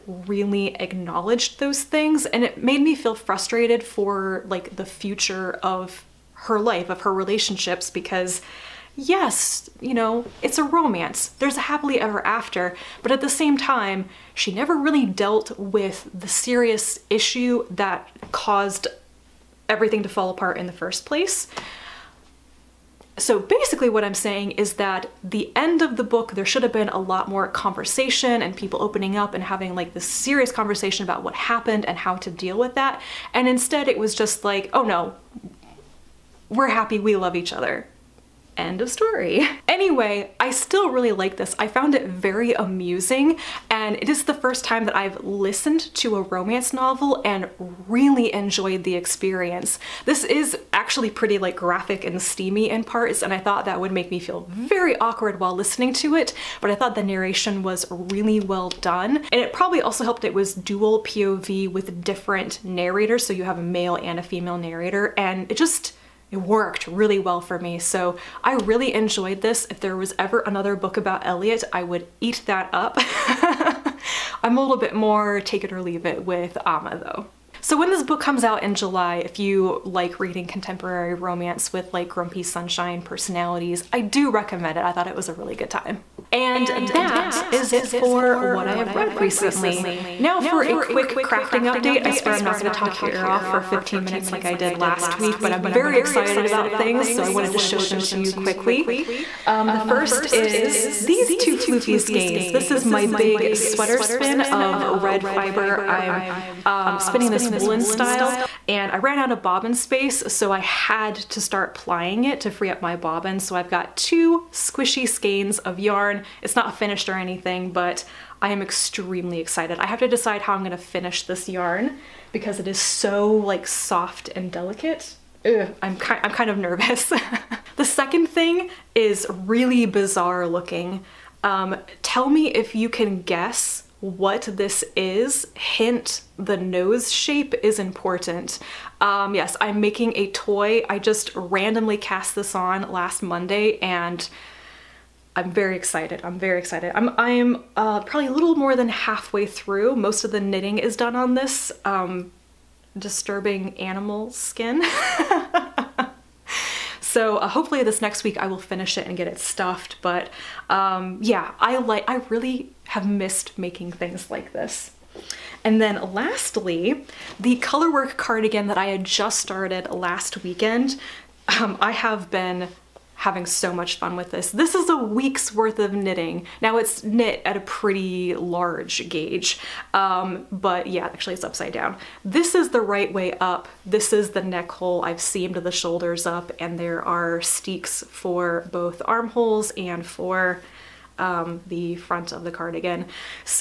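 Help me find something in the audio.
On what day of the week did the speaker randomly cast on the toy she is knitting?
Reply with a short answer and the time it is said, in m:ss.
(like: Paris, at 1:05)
Monday, at 2:23.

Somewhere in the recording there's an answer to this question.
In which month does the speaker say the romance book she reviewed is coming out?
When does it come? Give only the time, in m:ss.
1:18.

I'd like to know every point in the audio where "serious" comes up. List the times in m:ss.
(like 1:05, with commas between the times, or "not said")
0:16, 0:30.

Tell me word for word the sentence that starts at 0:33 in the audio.
And instead it was just like, oh no, we're happy, we love each other.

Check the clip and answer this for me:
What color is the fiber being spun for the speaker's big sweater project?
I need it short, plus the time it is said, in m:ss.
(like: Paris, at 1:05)
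Red, at 1:44.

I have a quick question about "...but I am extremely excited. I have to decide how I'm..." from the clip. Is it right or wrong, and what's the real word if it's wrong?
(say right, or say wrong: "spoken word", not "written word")
right.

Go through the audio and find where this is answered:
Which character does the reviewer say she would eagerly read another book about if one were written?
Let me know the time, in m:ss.
1:11.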